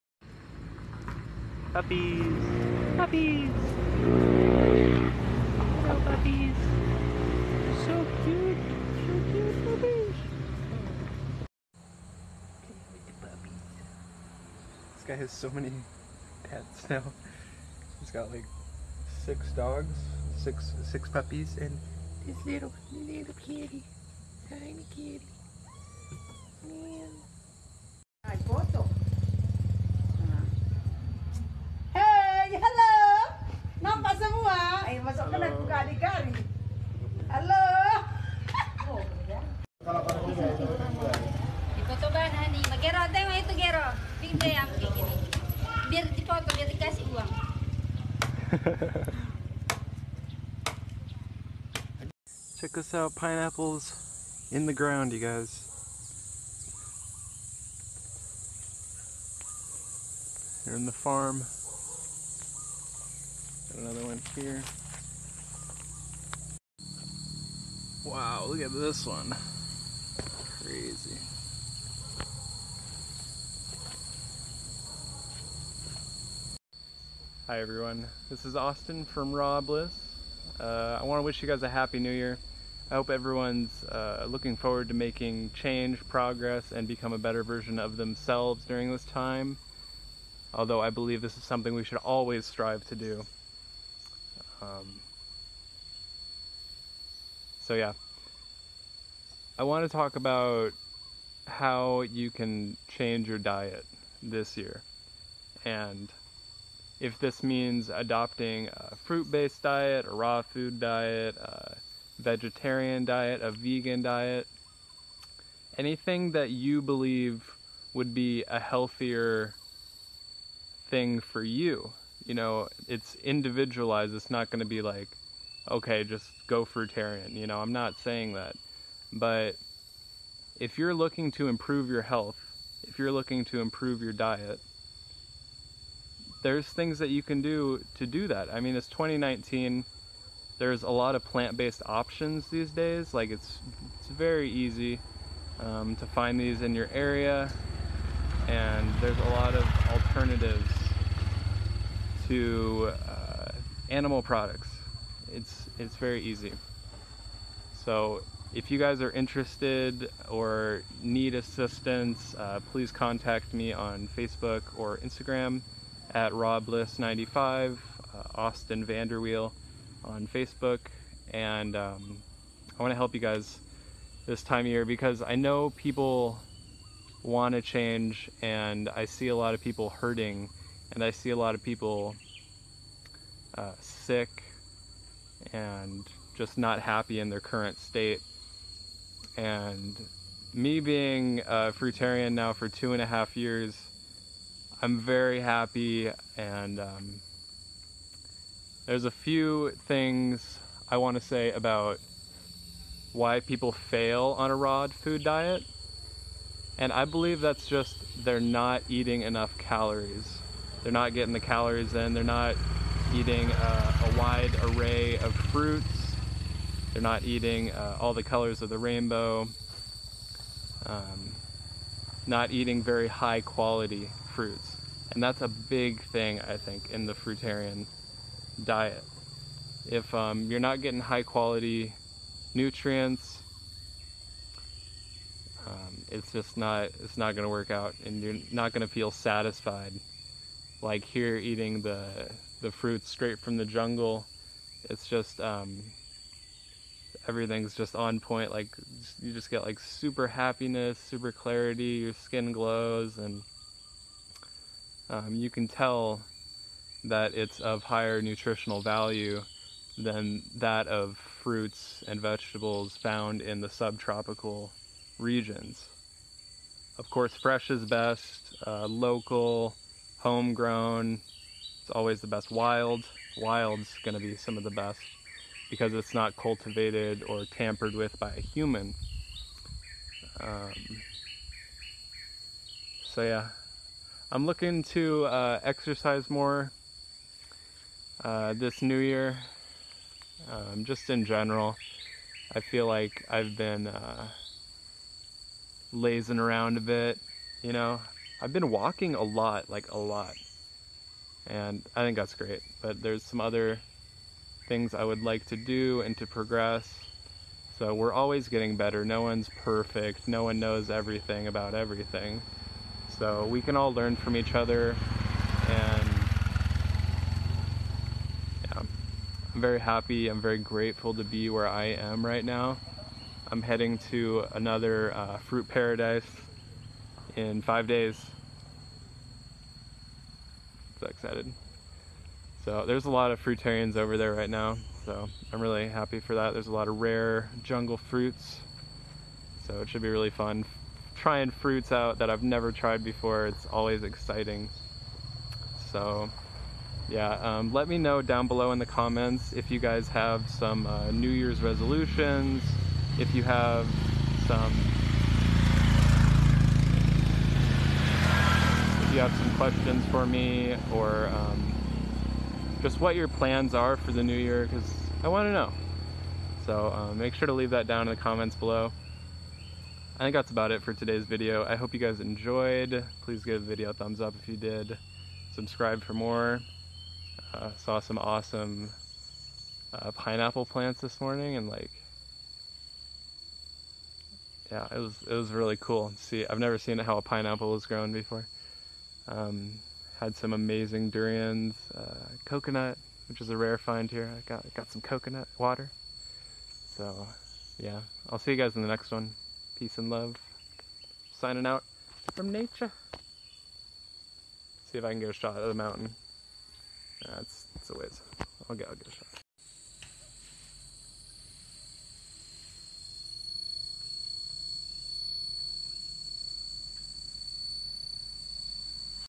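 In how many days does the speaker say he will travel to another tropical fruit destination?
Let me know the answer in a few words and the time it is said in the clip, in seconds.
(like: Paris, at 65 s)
5, at 327 s.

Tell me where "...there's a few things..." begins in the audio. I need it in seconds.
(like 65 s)
198 s.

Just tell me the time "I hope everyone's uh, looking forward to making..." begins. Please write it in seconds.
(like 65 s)
82 s.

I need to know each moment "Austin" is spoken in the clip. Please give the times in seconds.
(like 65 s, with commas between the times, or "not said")
78 s, 168 s.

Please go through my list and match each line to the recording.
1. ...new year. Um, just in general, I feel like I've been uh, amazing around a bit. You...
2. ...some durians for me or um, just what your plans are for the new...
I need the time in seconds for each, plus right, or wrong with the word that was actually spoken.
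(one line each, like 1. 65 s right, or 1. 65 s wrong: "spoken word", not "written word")
1. 288 s wrong: "lazing", not "amazing"
2. 359 s wrong: "questions", not "durians".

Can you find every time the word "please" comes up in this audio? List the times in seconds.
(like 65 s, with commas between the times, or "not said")
162 s, 373 s.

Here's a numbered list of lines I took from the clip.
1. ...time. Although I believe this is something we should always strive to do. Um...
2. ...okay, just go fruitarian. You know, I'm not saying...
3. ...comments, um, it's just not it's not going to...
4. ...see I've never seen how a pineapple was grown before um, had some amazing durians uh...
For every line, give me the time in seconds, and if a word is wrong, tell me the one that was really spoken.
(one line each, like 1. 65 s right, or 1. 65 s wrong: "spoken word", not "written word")
1. 89 s right
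2. 125 s right
3. 232 s wrong: "nutrients", not "comments"
4. 386 s right.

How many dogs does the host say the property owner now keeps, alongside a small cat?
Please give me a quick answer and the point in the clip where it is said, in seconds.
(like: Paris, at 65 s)
6, at 19 s.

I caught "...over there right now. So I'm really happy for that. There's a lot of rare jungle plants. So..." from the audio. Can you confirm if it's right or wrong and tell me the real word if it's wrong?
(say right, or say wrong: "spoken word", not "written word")
wrong: "fruits", not "plants".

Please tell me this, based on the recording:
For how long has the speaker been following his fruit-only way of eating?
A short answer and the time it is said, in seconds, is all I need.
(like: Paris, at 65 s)
2 and a half years, at 192 s.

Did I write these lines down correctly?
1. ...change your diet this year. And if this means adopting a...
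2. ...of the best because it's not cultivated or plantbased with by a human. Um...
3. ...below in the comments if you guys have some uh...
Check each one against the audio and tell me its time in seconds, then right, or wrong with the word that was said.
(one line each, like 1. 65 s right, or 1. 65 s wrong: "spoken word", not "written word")
1. 102 s right
2. 274 s wrong: "tampered", not "plantbased"
3. 348 s right.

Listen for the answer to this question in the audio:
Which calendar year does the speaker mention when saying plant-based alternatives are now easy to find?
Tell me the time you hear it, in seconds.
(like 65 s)
138 s.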